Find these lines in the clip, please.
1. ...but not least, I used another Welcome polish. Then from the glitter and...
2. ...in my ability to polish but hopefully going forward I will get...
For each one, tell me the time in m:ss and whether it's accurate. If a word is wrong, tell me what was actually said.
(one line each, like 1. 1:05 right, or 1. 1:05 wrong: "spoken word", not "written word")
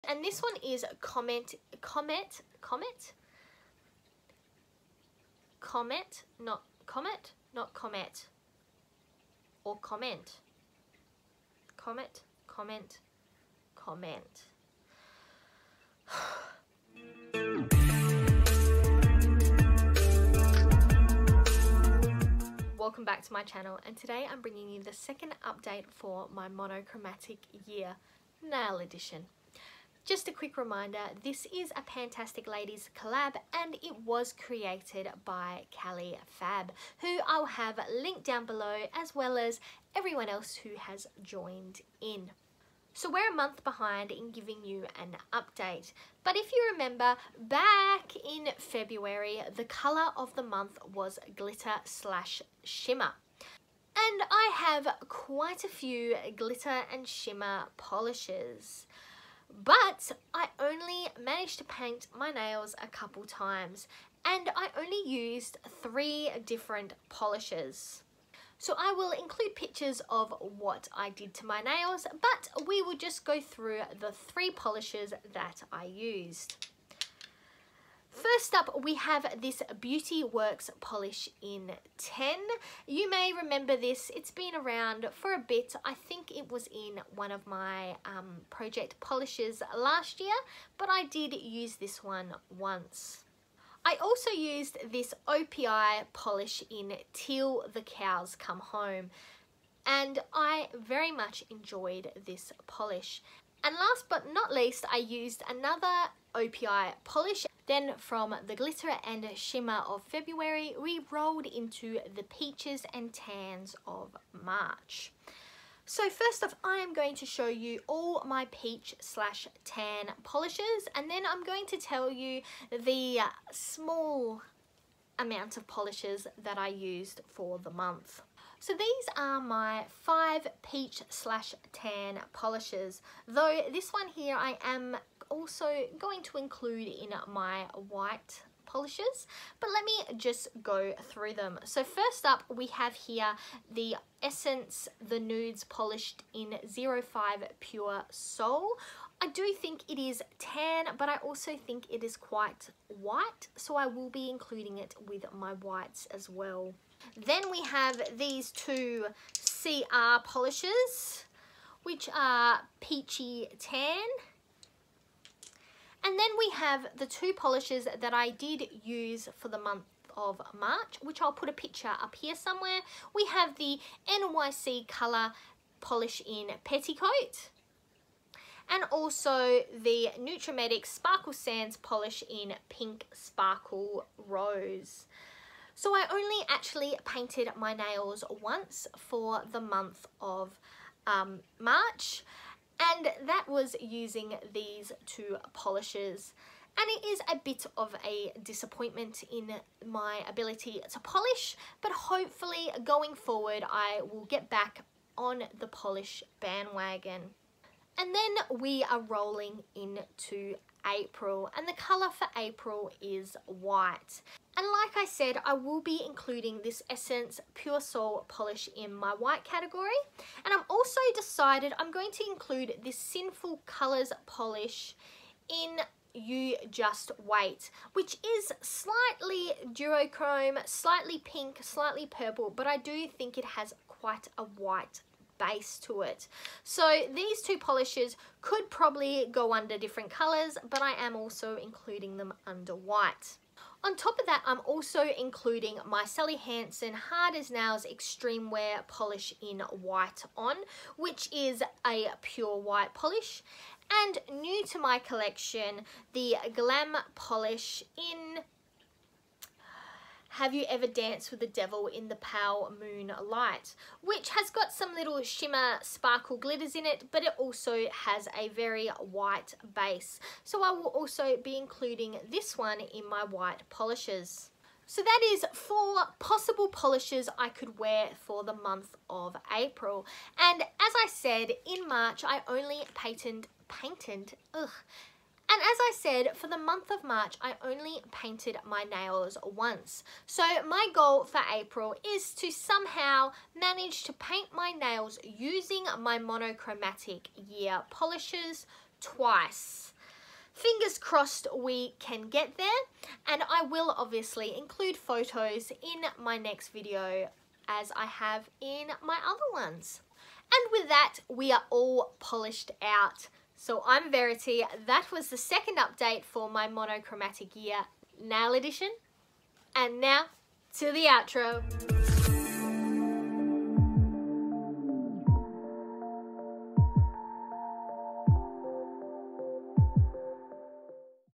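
1. 1:44 wrong: "OPI", not "Welcome"
2. 3:19 right.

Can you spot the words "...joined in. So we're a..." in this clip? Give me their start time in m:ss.
0:41.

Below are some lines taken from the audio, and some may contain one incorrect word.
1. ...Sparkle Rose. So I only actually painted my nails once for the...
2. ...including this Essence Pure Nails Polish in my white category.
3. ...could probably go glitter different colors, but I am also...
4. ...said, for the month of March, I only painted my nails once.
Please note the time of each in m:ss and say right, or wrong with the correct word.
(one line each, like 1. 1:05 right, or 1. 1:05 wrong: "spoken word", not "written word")
1. 3:03 right
2. 3:36 wrong: "Soul", not "Nails"
3. 3:58 wrong: "under", not "glitter"
4. 4:45 right.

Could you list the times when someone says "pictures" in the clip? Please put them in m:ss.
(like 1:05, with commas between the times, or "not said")
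1:09, 2:51.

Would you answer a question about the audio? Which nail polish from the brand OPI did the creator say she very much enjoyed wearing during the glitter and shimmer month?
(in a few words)
Till the Cows Come Home.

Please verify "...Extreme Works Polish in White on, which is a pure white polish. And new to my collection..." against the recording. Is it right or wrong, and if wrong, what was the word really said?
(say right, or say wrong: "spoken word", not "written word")
wrong: "Wear", not "Works".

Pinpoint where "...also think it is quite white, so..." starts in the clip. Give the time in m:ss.
2:31.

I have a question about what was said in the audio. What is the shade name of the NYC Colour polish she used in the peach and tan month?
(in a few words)
Petticoat.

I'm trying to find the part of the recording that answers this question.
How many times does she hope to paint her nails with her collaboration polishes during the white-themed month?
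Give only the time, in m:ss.
4:58.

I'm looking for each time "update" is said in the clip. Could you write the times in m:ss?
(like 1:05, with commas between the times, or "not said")
0:25, 0:45, 5:15.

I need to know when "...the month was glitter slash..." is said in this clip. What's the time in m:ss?
0:50.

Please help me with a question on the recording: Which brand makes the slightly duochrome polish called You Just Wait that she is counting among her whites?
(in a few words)
Sinful Colours.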